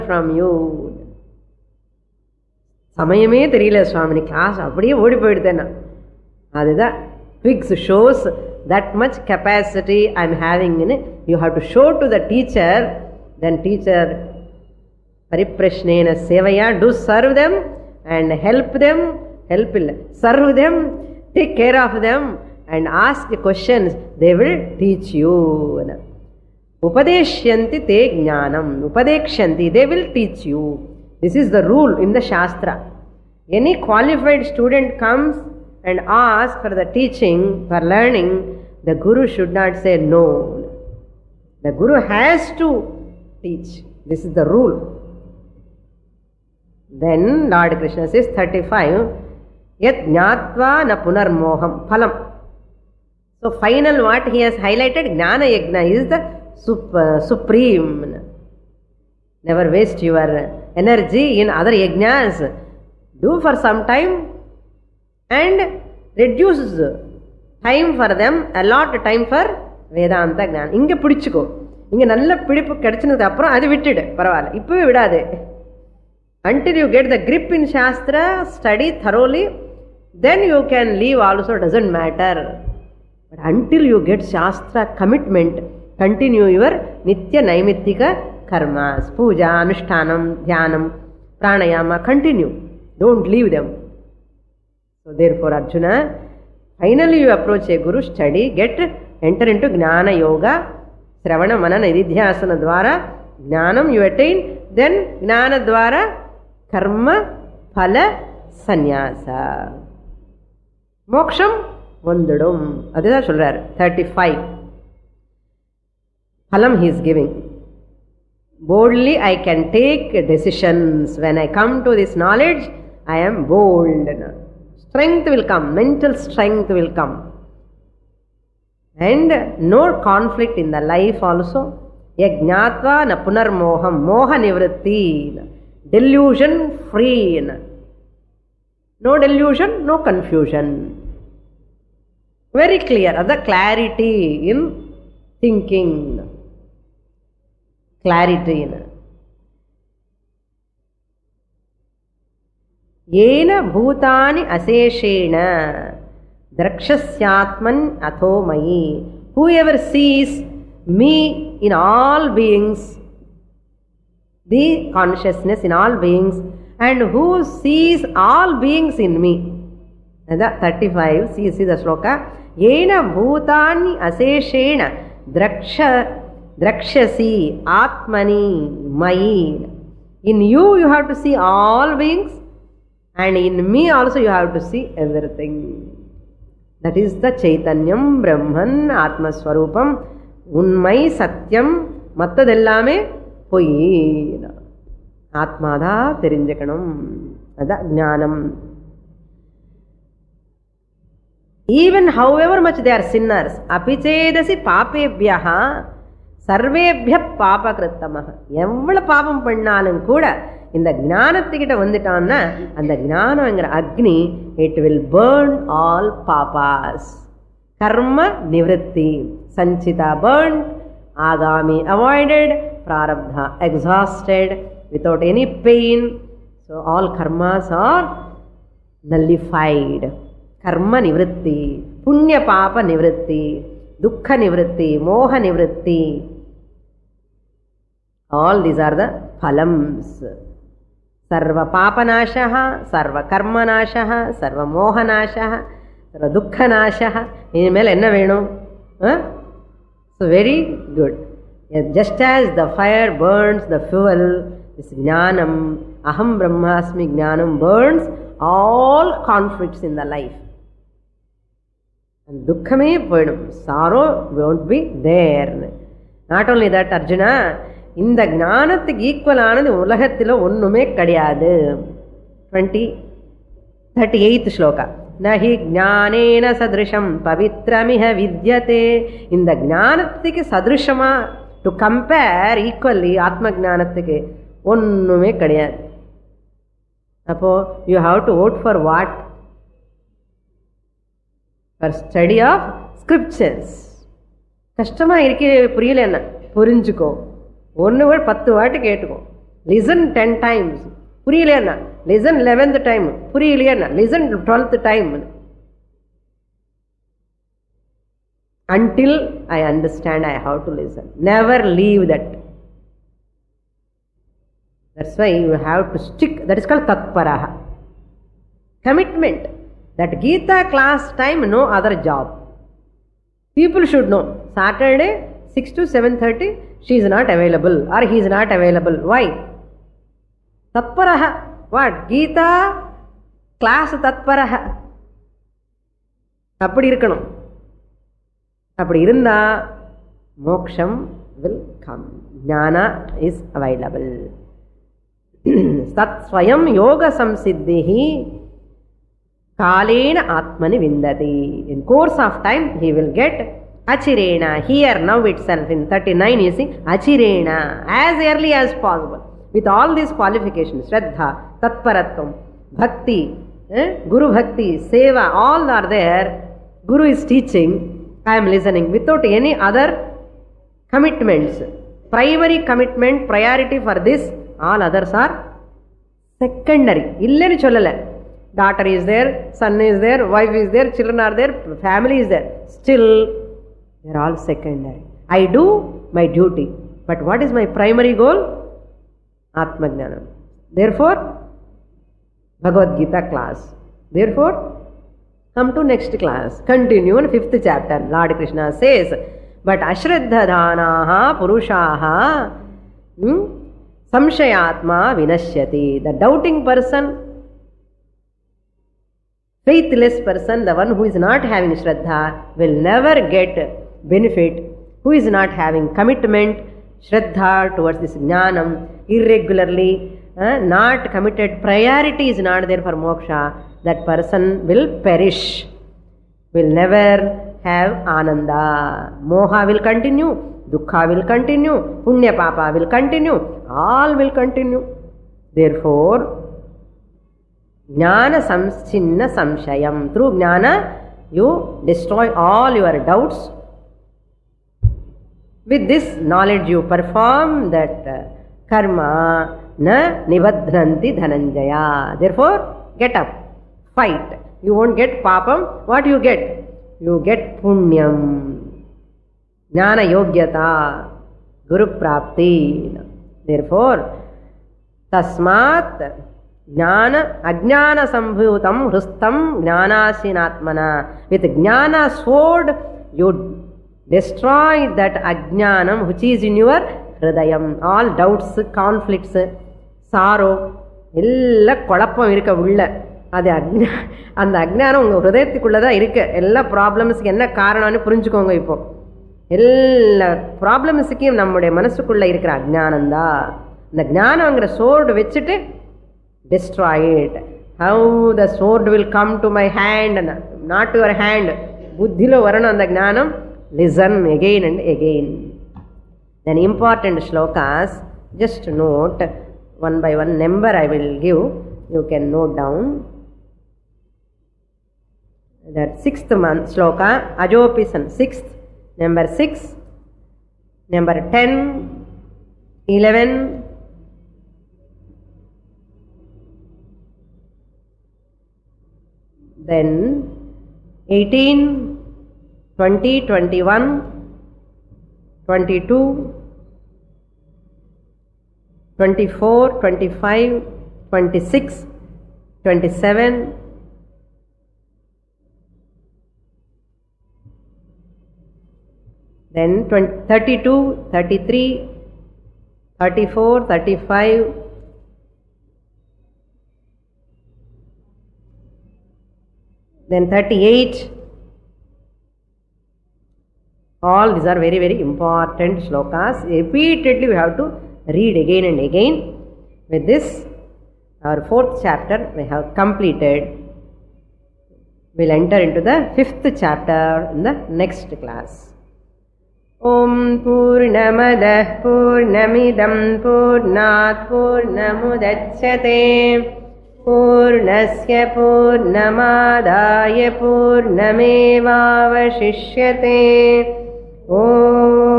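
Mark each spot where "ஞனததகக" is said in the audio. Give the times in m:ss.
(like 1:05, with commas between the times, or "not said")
4:28, 4:39.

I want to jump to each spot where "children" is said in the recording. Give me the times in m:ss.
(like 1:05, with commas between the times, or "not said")
6:20.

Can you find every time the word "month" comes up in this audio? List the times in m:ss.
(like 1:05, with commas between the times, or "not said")
8:36.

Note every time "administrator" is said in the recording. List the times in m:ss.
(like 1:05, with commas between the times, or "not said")
not said.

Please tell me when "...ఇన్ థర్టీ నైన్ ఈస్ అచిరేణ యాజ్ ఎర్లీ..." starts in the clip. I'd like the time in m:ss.
5:55.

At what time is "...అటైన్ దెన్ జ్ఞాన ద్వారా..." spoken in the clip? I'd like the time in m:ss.
1:44.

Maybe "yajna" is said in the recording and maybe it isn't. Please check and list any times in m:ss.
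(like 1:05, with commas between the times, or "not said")
0:55, 1:01.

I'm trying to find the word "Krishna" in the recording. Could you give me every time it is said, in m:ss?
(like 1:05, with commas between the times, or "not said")
0:47, 6:38.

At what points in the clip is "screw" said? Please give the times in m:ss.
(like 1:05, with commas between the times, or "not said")
not said.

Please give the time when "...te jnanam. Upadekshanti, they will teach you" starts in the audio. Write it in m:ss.
0:27.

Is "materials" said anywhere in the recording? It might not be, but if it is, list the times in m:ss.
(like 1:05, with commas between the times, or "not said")
not said.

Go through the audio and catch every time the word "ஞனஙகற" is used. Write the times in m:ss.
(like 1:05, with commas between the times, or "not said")
3:33, 8:14.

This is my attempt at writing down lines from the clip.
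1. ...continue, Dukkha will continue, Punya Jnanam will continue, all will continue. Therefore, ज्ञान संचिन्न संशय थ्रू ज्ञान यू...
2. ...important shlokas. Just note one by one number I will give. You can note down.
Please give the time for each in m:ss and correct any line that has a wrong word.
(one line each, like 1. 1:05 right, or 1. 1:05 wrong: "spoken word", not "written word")
1. 7:09 wrong: "Papa", not "Jnanam"
2. 8:26 right.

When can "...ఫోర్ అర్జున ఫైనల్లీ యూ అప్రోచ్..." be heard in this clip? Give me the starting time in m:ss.
1:35.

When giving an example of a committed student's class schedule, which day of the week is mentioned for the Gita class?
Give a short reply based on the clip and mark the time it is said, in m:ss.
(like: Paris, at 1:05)
Saturday, at 5:24.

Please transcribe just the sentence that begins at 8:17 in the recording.
How the sword will come to my hand not your hand.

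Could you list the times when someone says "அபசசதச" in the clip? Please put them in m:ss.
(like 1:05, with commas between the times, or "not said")
3:23.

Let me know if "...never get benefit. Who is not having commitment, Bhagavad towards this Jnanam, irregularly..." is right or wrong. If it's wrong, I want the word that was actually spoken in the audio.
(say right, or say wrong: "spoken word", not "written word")
wrong: "Shraddha", not "Bhagavad".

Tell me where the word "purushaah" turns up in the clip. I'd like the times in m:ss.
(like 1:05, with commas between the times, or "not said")
6:41.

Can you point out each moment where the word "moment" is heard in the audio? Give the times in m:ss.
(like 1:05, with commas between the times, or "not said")
not said.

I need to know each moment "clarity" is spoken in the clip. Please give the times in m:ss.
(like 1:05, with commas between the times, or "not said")
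2:23, 2:28.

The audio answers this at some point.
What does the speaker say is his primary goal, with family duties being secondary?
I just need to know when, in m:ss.
6:29.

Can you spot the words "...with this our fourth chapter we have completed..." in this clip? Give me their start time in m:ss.
9:29.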